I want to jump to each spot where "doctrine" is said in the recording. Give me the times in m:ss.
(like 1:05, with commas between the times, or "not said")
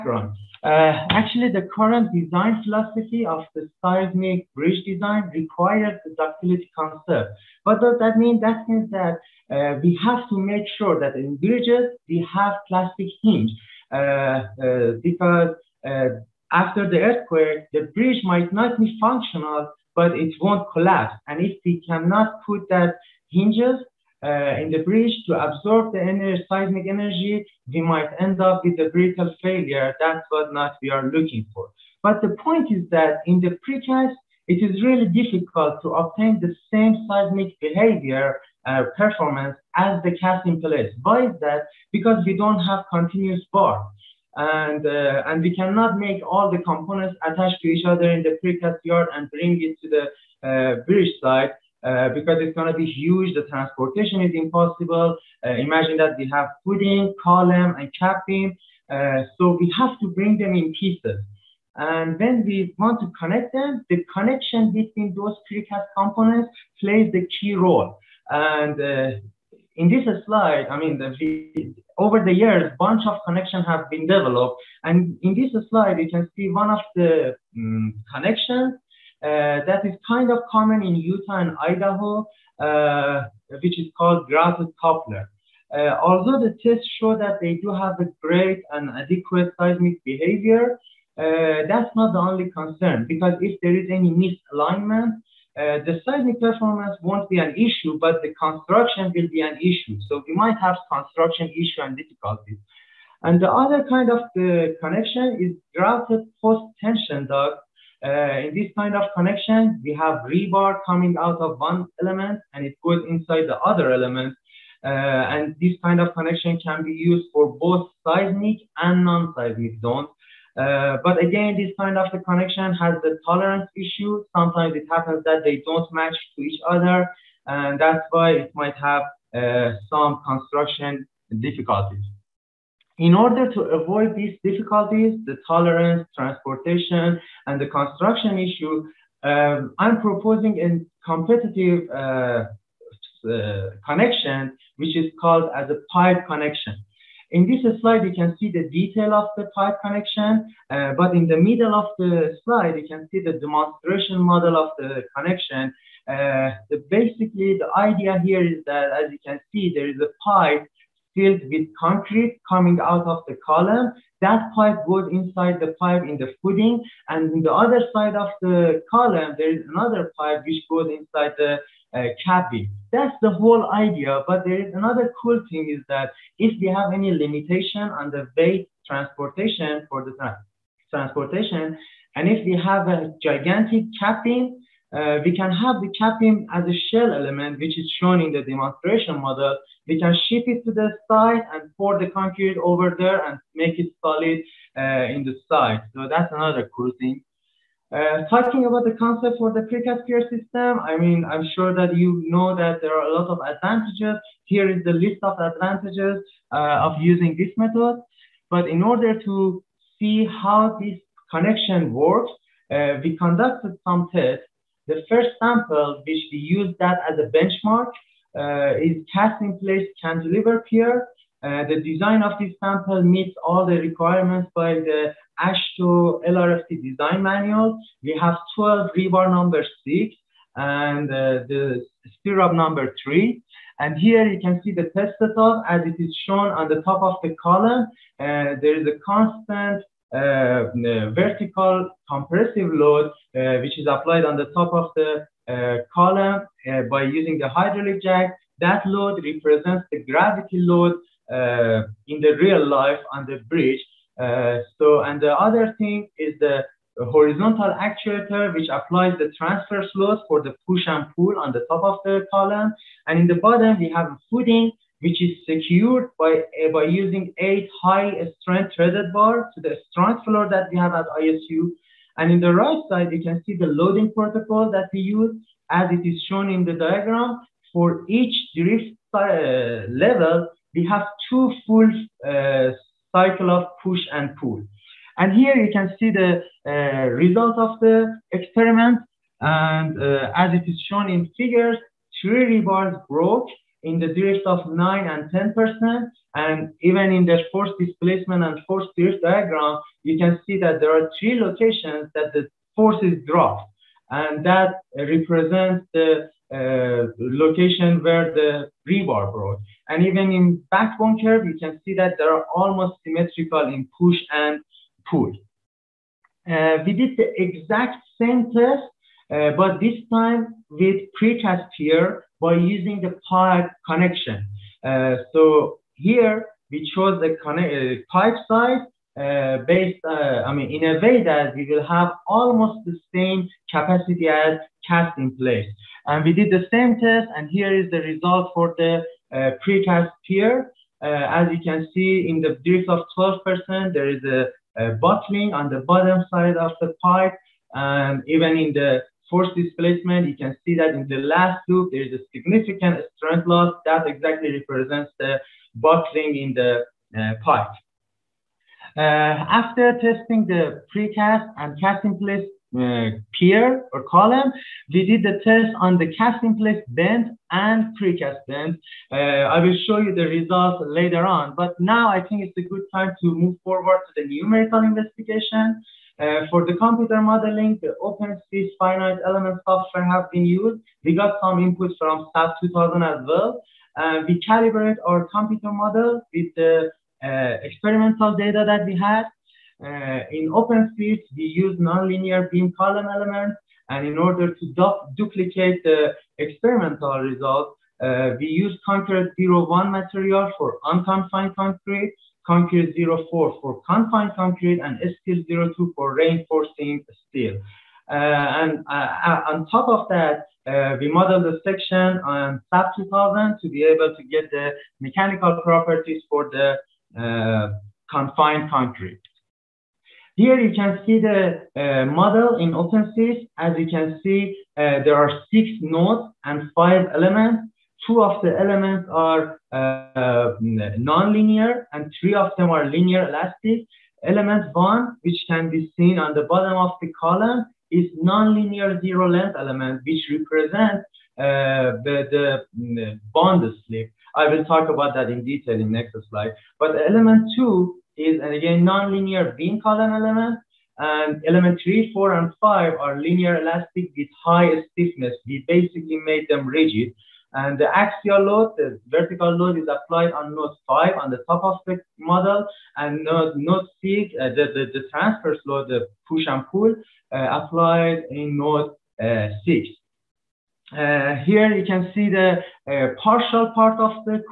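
not said.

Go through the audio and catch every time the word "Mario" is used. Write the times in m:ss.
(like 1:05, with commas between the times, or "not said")
not said.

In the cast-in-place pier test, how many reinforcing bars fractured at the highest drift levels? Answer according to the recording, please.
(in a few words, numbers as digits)
3.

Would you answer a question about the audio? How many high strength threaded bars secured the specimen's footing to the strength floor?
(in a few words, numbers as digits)
8.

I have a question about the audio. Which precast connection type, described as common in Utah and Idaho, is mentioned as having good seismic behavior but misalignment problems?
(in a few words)
Grouted coupler.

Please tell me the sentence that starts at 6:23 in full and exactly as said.
Uh, we calibrate our computer model with the uh, experimental data that we had.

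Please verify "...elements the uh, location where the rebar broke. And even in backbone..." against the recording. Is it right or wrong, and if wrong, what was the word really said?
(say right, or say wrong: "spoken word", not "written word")
wrong: "represents", not "elements".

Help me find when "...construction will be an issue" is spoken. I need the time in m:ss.
1:38.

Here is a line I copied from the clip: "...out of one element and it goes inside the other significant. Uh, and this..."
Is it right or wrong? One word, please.
wrong.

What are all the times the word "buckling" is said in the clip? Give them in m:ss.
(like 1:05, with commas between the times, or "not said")
5:44, 5:55.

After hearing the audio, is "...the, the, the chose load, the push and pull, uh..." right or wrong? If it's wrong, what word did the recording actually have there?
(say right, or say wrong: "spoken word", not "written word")
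wrong: "transverse", not "chose".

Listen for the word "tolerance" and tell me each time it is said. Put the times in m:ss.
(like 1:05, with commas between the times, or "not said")
2:03, 2:15.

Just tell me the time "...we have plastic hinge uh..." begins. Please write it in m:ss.
0:12.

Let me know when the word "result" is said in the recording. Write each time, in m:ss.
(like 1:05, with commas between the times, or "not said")
4:47, 5:37, 6:10, 6:37.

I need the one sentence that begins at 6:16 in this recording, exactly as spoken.
Uh, for the computer modeling, the OpenSees' finite element software have been used.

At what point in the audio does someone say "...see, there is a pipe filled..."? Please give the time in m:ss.
2:39.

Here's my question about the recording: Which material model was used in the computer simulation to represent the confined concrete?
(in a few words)
Concrete04.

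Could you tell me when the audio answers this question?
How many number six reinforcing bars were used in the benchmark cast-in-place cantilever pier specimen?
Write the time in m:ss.
3:48.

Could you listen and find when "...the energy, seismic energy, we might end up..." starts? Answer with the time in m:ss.
0:25.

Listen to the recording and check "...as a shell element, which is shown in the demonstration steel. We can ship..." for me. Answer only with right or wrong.
wrong.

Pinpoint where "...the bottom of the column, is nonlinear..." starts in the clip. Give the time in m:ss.
7:16.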